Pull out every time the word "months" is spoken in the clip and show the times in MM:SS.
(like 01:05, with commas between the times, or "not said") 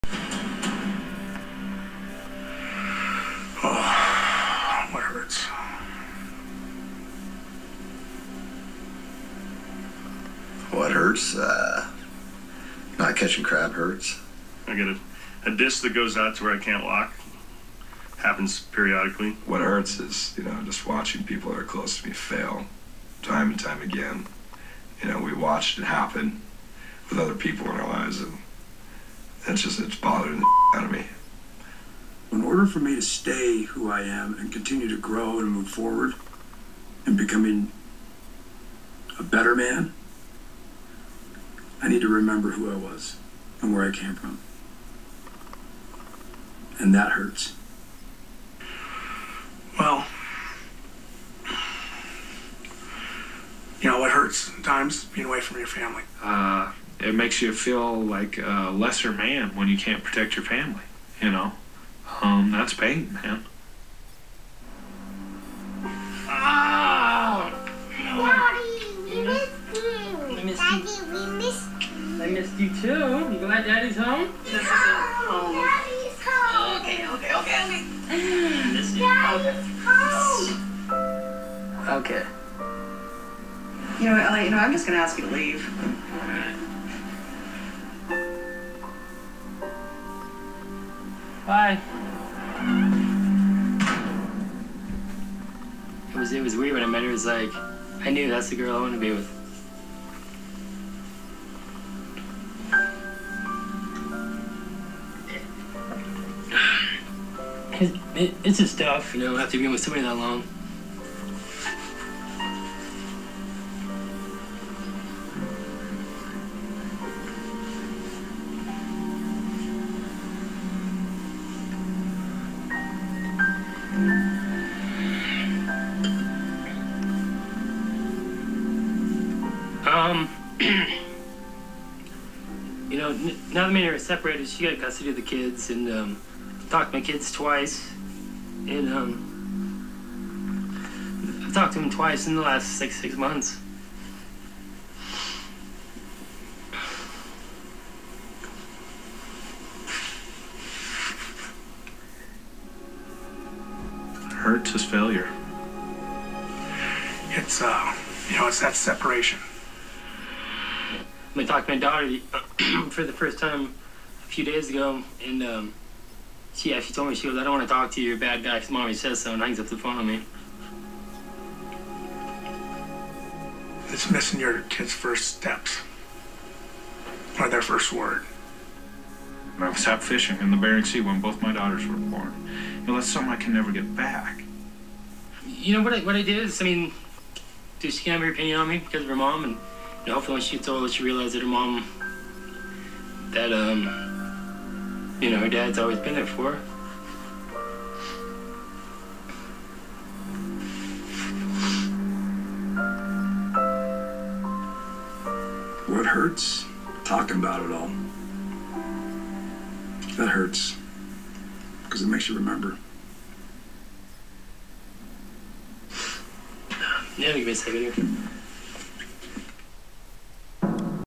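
02:23.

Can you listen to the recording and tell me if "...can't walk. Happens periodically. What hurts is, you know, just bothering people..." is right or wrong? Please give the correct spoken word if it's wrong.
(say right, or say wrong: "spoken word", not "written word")
wrong: "watching", not "bothering".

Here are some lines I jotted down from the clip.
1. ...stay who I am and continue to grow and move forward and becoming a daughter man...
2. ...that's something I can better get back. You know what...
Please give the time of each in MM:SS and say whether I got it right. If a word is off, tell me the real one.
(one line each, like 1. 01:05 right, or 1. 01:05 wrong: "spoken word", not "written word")
1. 00:33 wrong: "better", not "daughter"
2. 03:02 wrong: "never", not "better".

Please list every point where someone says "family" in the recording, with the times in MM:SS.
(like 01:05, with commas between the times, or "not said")
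00:55, 01:00.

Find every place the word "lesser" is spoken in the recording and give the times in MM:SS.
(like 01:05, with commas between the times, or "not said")
00:58.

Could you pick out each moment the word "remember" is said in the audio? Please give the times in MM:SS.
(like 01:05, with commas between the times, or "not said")
00:42, 03:32.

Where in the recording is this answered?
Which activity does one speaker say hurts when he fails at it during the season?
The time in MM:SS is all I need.
00:13.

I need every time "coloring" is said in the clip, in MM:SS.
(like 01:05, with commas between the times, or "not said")
not said.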